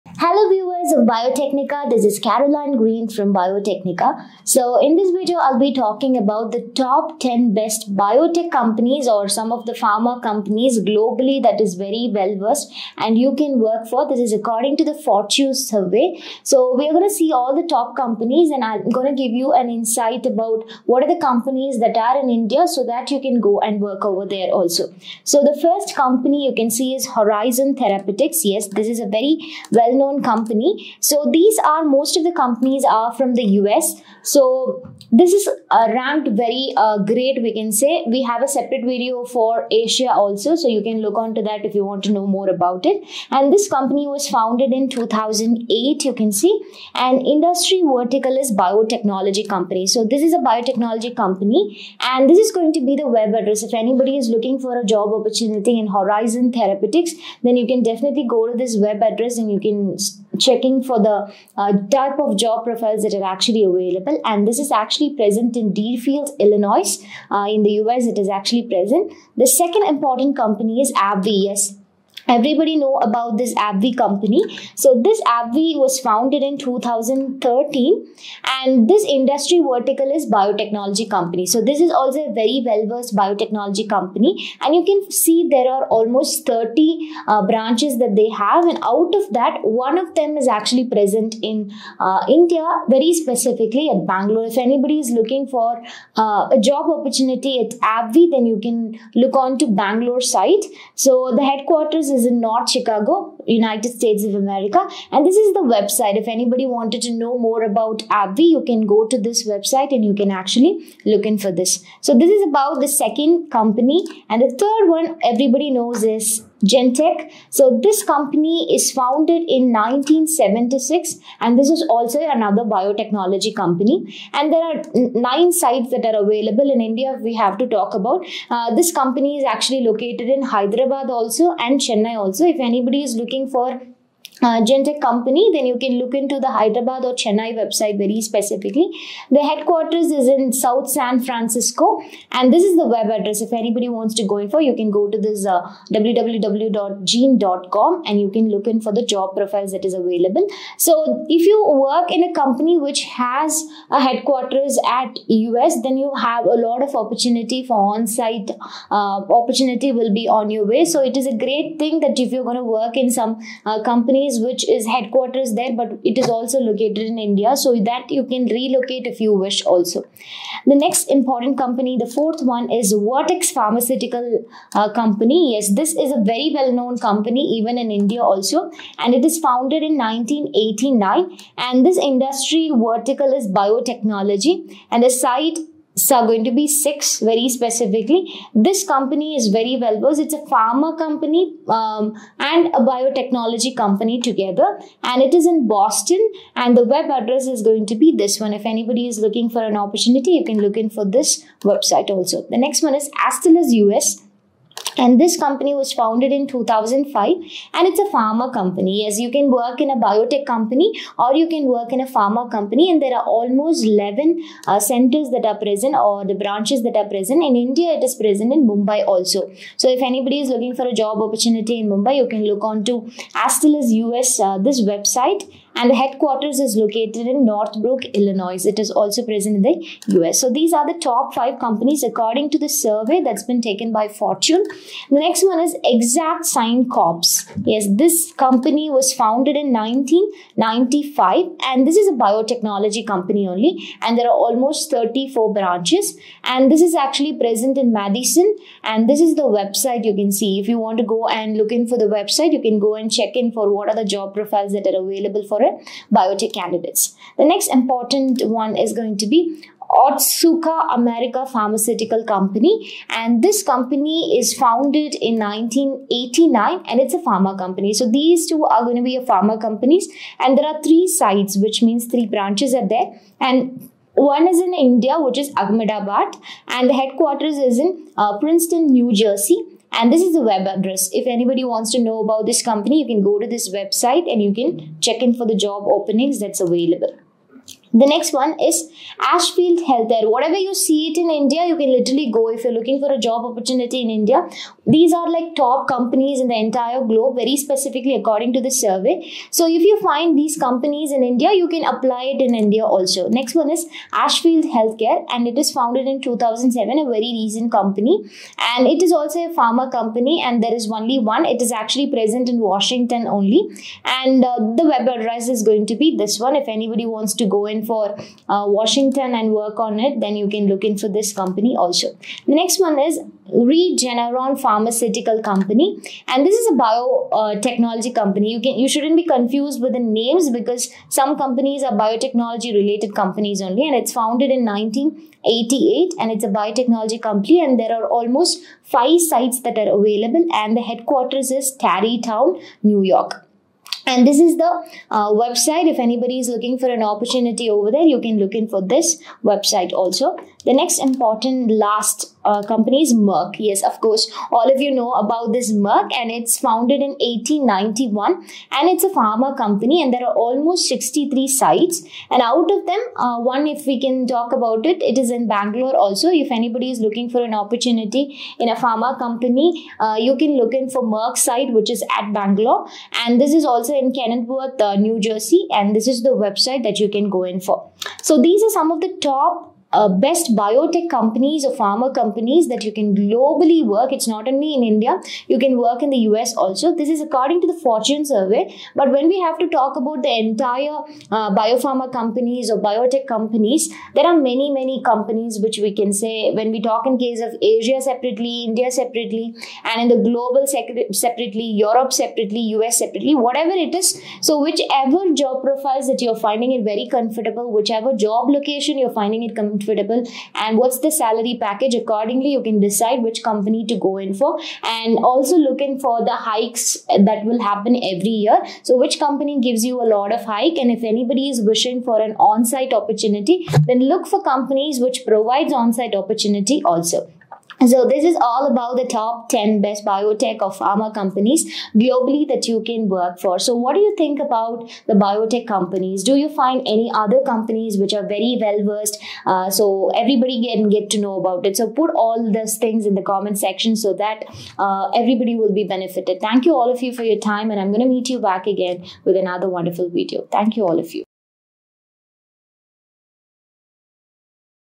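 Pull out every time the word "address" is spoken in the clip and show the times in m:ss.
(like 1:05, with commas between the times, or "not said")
0:53, 0:59, 2:23, 3:17, 4:40, 5:15.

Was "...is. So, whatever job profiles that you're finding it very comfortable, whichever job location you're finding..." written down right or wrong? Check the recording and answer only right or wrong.
wrong.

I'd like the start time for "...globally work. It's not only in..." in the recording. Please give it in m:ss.
6:23.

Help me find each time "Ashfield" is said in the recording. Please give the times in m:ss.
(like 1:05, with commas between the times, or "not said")
4:49, 5:04.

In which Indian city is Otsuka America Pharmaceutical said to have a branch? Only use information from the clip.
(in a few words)
Ahmedabad.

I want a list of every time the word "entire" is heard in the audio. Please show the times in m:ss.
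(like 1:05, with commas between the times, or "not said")
4:56, 6:30.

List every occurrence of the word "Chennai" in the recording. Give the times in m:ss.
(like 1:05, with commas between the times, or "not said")
2:11, 2:17.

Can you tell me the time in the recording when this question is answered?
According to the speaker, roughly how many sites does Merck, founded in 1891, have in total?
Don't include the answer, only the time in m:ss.
6:00.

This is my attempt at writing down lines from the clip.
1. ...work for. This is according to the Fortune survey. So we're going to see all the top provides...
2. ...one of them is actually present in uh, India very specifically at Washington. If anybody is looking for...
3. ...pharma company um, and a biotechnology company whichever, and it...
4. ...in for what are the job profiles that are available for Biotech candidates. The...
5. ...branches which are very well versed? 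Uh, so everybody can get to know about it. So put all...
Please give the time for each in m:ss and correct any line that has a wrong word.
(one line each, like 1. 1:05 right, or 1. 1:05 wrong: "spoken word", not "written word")
1. 0:13 wrong: "companies", not "provides"
2. 1:29 wrong: "Bangalore", not "Washington"
3. 3:10 wrong: "together", not "whichever"
4. 4:13 right
5. 7:17 wrong: "companies", not "branches".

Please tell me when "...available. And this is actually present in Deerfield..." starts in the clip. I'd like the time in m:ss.
1:03.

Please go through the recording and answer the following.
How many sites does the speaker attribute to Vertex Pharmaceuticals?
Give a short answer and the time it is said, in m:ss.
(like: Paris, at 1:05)
6, at 3:06.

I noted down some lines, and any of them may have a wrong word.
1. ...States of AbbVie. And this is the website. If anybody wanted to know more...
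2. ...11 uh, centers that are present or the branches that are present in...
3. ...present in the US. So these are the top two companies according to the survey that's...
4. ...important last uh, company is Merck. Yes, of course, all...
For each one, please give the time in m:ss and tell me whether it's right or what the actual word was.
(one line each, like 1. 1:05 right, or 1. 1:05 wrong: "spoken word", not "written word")
1. 1:43 wrong: "America", not "AbbVie"
2. 3:33 right
3. 3:49 wrong: "five", not "two"
4. 5:50 right.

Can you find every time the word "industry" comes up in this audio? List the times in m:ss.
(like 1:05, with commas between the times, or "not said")
0:47, 1:19, 3:02.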